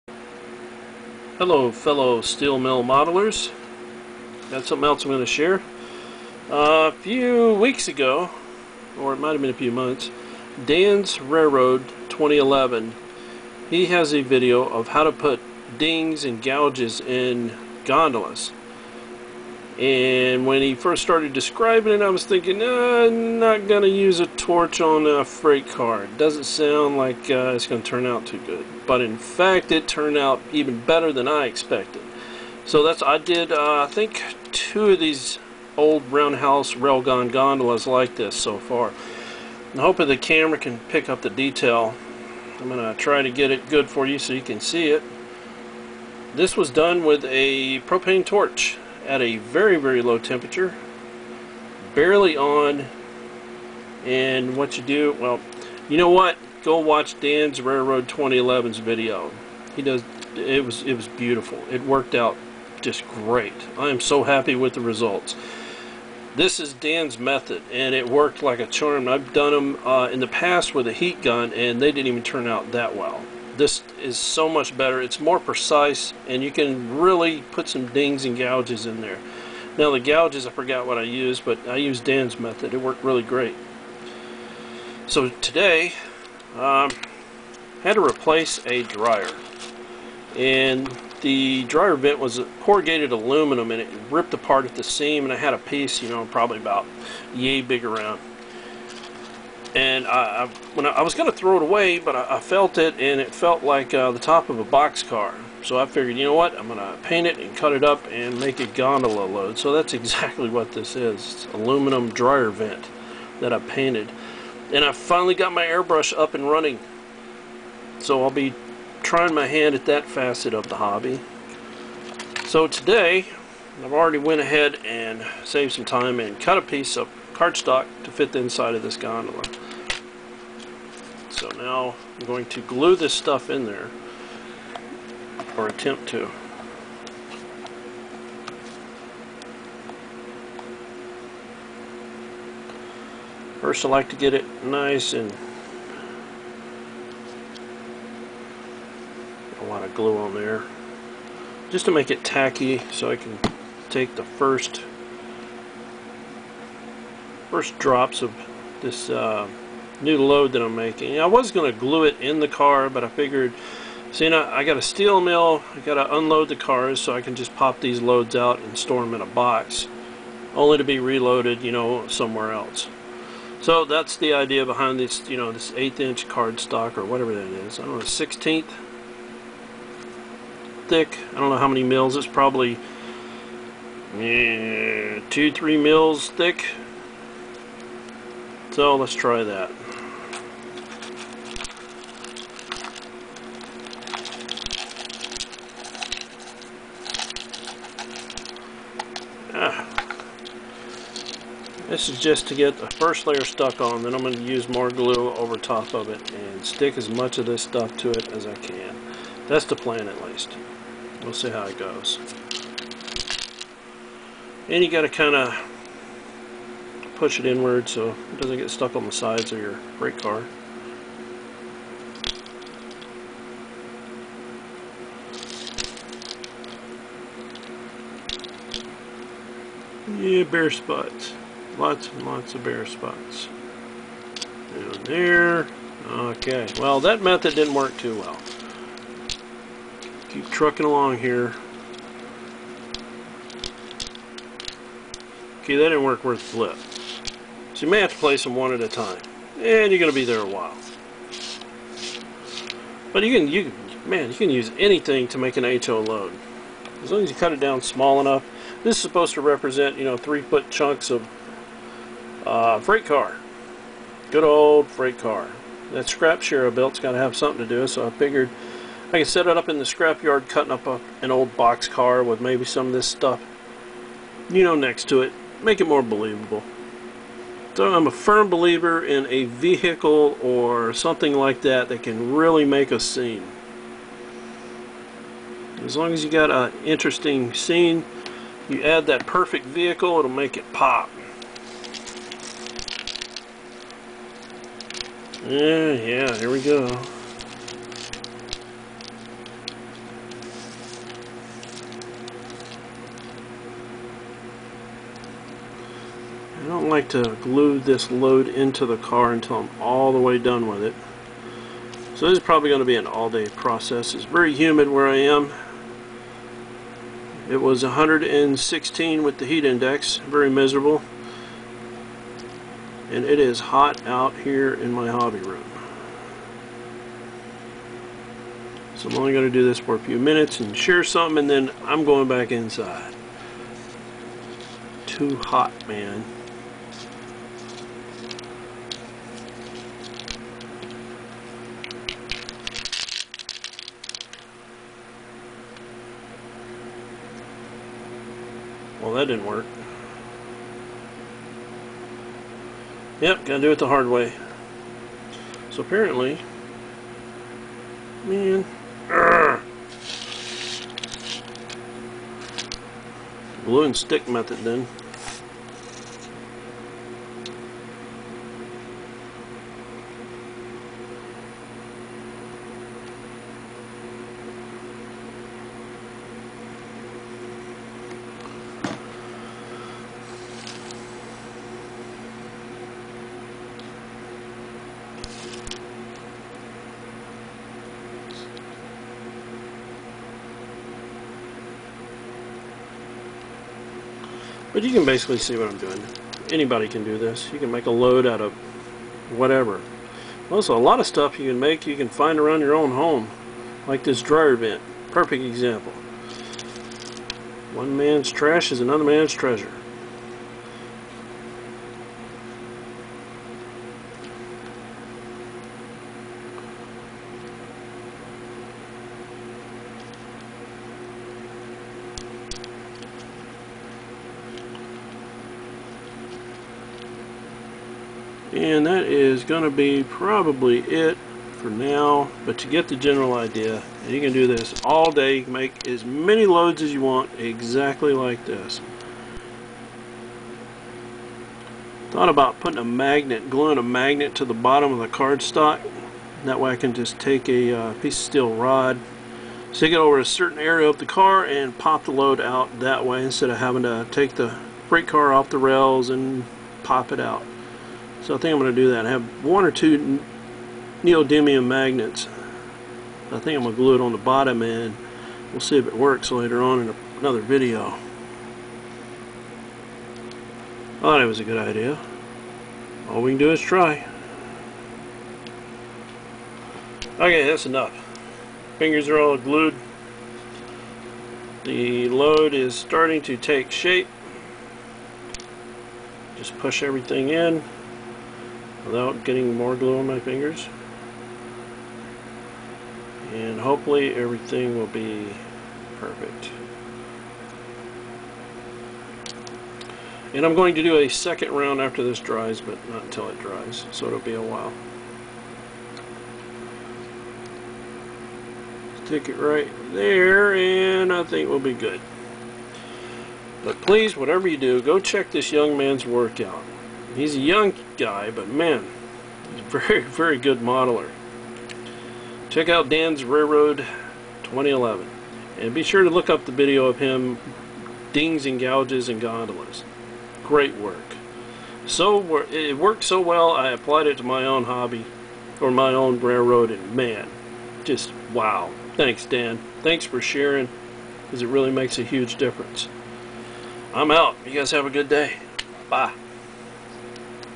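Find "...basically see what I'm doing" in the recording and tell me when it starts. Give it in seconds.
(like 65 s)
395 s.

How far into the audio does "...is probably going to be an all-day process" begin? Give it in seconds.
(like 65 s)
312 s.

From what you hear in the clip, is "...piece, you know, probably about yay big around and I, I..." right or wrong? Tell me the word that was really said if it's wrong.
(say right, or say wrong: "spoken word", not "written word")
right.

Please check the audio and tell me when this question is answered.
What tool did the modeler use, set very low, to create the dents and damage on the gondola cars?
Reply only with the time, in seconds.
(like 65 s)
47 s.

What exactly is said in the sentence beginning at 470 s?
I thought it was a good idea.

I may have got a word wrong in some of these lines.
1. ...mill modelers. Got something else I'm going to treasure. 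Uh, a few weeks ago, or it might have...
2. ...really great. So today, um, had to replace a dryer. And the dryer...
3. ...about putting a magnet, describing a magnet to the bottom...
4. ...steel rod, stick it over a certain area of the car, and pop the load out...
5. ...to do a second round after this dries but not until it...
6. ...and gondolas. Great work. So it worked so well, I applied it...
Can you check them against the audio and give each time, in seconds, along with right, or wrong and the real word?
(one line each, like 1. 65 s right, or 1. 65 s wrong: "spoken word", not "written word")
1. 2 s wrong: "share", not "treasure"
2. 83 s right
3. 442 s wrong: "gluing", not "describing"
4. 448 s right
5. 500 s right
6. 529 s right.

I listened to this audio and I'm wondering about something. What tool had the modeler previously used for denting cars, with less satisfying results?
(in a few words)
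Heat gun.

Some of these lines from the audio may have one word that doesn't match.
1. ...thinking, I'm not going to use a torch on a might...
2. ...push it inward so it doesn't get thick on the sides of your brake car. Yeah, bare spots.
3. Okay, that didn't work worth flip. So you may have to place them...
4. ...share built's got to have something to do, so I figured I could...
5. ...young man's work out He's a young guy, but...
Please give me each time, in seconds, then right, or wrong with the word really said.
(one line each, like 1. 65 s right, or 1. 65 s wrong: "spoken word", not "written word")
1. 22 s wrong: "freight", not "might"
2. 217 s wrong: "stuck", not "thick"
3. 245 s right
4. 266 s right
5. 515 s right.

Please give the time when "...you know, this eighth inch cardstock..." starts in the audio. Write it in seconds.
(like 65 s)
175 s.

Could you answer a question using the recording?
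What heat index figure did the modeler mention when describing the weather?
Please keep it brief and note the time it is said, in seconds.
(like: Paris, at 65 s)
116, at 317 s.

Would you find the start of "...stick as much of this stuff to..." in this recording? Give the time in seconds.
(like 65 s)
206 s.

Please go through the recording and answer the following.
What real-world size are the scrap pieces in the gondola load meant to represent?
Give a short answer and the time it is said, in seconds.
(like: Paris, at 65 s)
3 foot chunks, at 260 s.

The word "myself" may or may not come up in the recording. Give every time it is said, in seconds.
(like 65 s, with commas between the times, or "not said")
not said.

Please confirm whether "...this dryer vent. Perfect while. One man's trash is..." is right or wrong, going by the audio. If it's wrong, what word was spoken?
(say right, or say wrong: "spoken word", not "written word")
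wrong: "example", not "while".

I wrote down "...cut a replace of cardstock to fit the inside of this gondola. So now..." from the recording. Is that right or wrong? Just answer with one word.
wrong.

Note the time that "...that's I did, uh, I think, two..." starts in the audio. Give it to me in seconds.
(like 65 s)
32 s.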